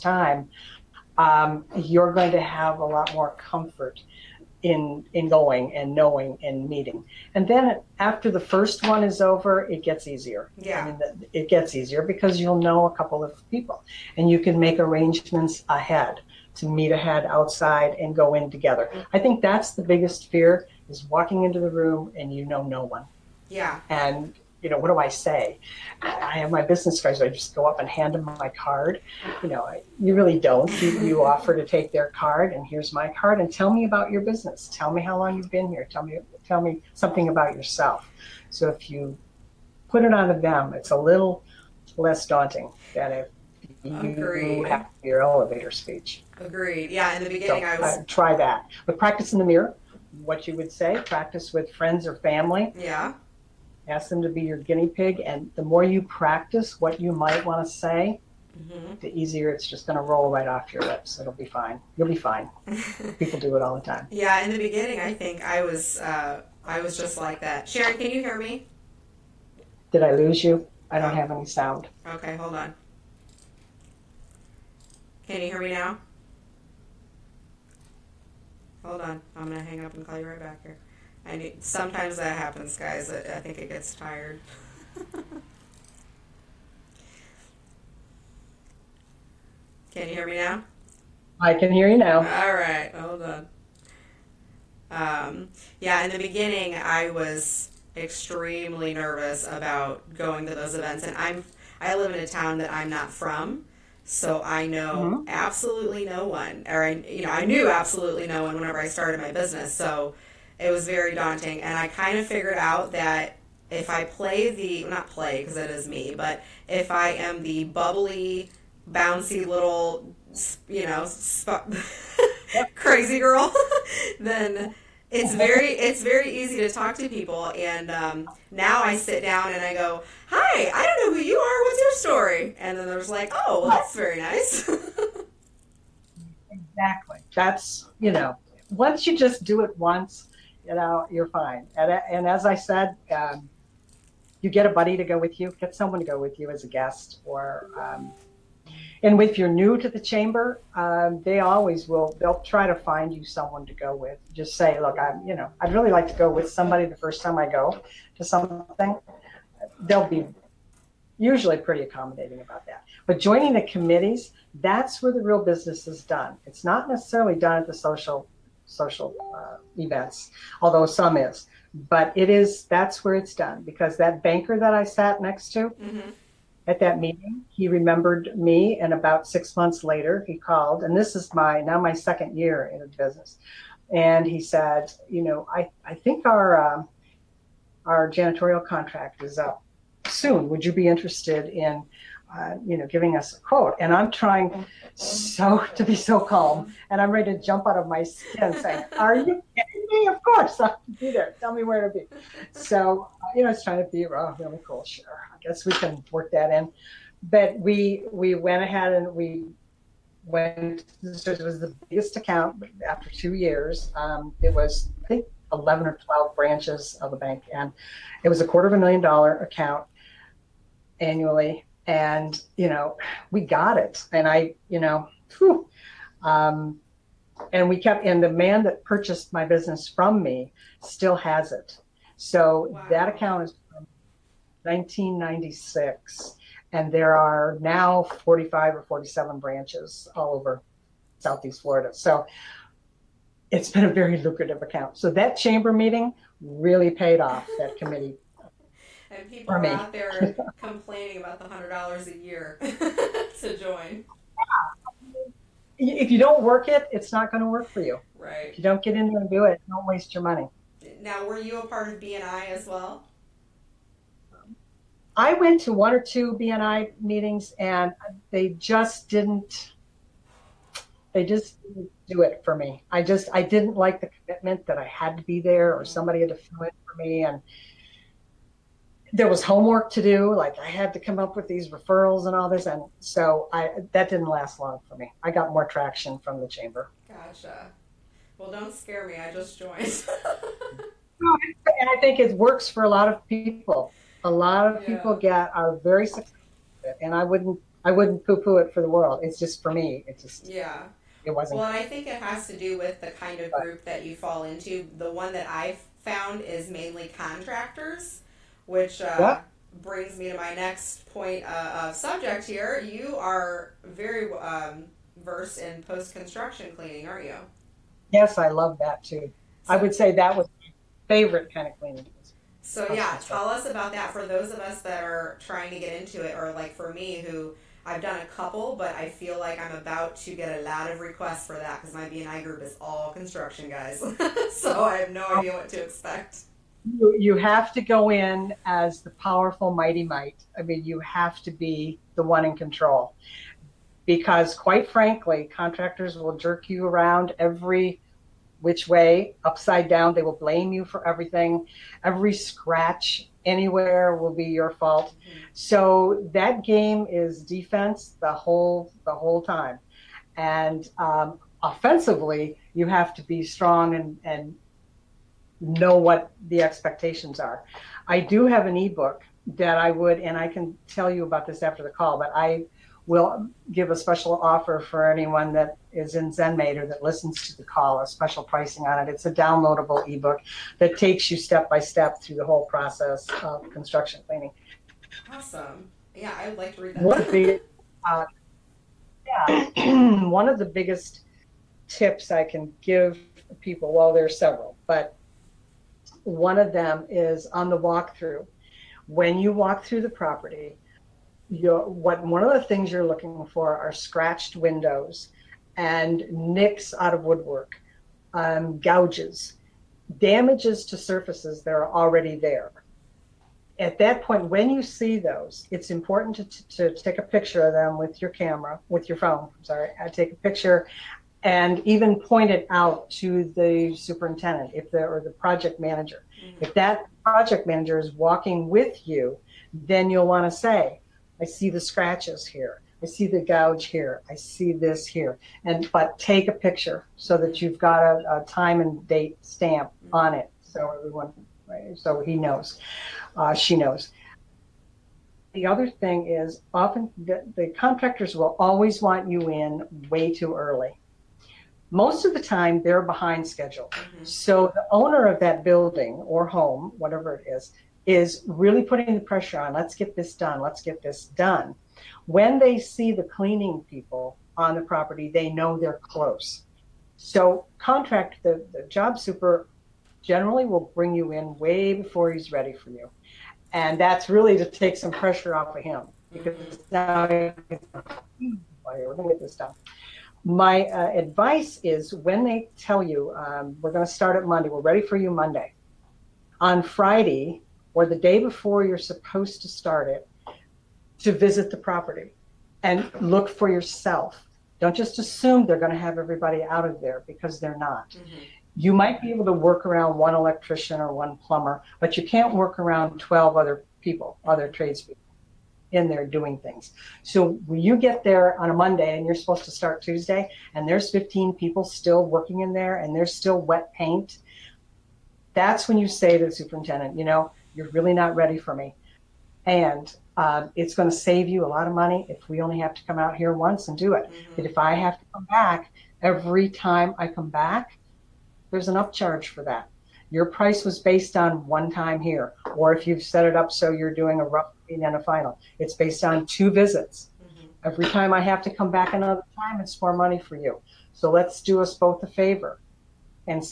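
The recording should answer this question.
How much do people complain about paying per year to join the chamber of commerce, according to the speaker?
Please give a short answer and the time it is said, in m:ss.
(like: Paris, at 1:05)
$100, at 4:11.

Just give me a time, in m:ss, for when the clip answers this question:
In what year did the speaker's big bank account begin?
3:54.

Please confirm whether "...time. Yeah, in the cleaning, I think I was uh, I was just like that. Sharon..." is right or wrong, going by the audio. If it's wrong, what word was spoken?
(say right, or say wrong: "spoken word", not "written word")
wrong: "beginning", not "cleaning".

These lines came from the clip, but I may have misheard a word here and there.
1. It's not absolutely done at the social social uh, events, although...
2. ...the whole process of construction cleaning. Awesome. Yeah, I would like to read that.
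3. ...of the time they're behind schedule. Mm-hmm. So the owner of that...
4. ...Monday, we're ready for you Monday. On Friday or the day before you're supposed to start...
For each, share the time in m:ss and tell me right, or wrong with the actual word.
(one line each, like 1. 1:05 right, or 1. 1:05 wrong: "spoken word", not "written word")
1. 2:46 wrong: "necessarily", not "absolutely"
2. 6:22 right
3. 7:32 right
4. 8:04 right.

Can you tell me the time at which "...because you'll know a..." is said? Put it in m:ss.
0:12.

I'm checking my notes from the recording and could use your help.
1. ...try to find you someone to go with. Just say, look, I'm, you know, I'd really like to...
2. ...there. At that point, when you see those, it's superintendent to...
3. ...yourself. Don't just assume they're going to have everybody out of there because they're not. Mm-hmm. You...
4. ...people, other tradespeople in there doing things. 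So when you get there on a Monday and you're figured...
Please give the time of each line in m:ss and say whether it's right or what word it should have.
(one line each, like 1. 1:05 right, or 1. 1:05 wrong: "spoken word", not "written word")
1. 2:32 right
2. 6:52 wrong: "important", not "superintendent"
3. 8:13 right
4. 8:24 wrong: "supposed", not "figured".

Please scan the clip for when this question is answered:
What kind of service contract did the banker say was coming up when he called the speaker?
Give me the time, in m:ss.
3:08.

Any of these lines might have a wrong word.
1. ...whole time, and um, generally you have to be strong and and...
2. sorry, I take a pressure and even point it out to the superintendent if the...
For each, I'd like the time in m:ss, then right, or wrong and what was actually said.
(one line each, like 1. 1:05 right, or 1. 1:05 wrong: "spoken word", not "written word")
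1. 5:59 wrong: "offensively", not "generally"
2. 6:59 wrong: "picture", not "pressure".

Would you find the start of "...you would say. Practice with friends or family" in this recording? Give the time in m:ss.
0:50.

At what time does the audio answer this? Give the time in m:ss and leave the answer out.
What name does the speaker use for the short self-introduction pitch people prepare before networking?
0:45.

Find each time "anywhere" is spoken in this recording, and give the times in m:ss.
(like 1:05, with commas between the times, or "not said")
5:53.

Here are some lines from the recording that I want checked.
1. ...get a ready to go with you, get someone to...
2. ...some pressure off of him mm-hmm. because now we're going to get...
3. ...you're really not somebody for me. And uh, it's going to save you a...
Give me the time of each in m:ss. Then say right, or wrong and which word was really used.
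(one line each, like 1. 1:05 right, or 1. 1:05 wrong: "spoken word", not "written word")
1. 2:24 wrong: "buddy", not "ready"
2. 7:54 right
3. 8:37 wrong: "ready", not "somebody".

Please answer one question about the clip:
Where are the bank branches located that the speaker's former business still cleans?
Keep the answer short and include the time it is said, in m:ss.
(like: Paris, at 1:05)
southeast Florida, at 4:01.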